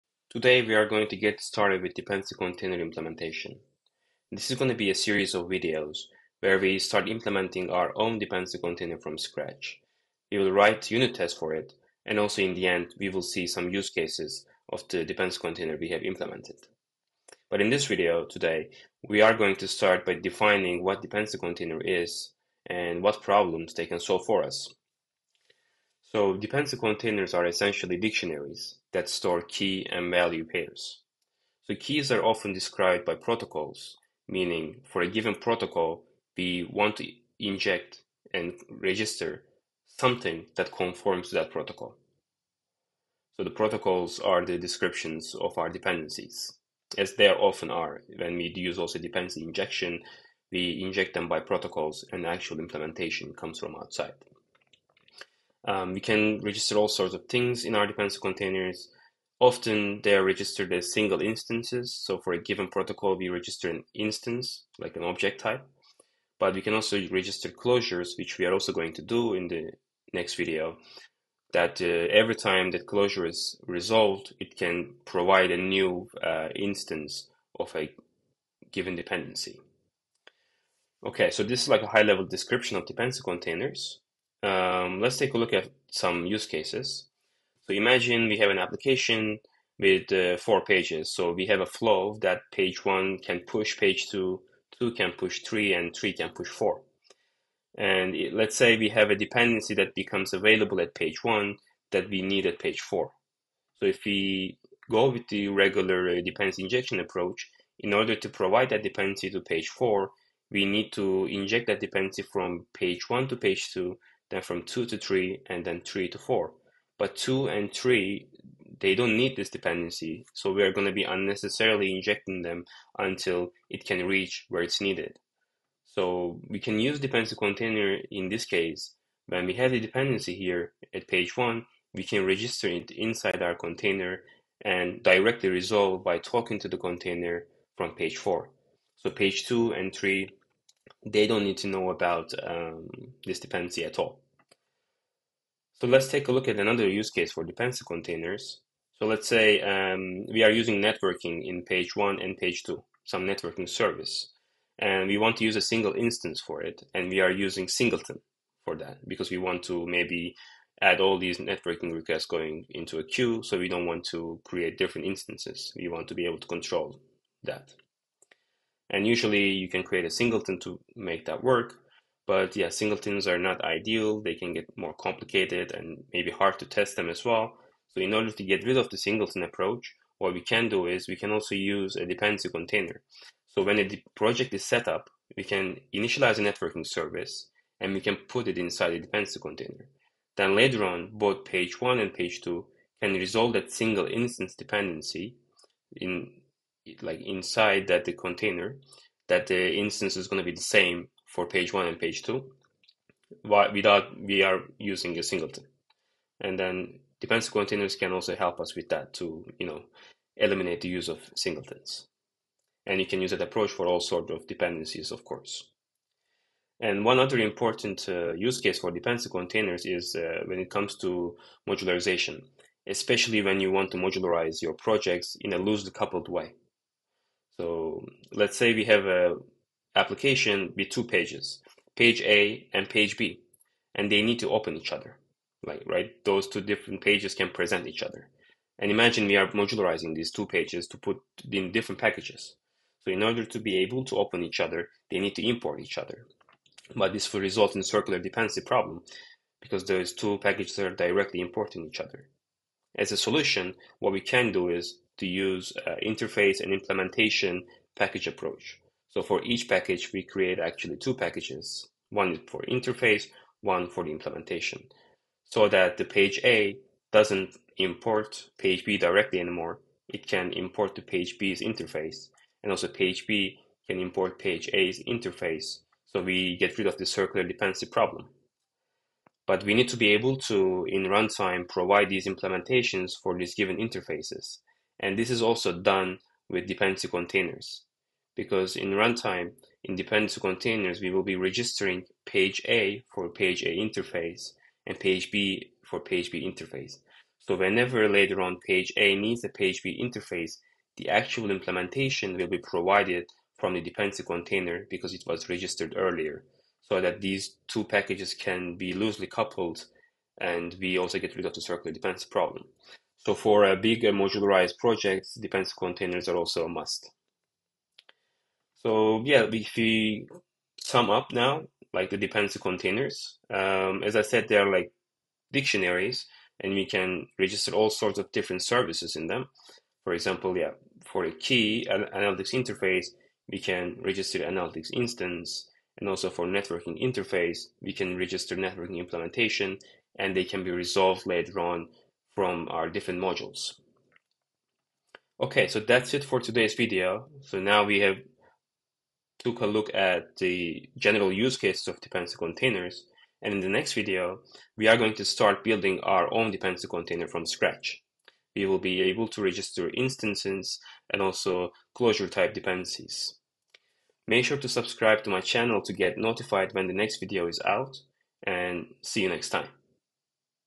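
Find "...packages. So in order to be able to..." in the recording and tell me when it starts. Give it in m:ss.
4:02.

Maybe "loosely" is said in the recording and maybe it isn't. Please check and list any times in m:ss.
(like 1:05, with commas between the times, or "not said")
3:45, 5:08.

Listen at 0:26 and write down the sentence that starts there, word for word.
So dependency containers are essentially dictionaries that store key and value pairs.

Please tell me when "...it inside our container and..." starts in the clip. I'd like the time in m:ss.
2:12.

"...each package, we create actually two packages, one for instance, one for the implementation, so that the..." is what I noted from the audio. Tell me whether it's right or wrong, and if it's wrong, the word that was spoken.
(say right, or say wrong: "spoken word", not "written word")
wrong: "interface", not "instance".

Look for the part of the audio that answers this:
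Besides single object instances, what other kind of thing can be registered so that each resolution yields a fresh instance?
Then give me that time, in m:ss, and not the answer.
1:07.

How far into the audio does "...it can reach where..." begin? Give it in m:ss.
2:03.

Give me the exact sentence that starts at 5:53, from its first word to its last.
And in the next video, we are going to start building our own dependency container from scratch.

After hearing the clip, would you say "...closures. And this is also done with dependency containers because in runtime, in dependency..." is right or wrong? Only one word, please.
wrong.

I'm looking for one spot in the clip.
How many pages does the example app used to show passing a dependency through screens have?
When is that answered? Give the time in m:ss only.
1:30.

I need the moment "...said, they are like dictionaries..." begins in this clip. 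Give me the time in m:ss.
5:24.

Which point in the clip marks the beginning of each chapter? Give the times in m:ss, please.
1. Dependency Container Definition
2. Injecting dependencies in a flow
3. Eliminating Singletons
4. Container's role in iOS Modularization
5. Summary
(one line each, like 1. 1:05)
1. 0:25
2. 1:24
3. 2:26
4. 3:36
5. 5:18.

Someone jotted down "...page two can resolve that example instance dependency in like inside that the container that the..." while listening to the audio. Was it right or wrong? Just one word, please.
wrong.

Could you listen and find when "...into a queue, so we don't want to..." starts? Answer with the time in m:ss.
2:42.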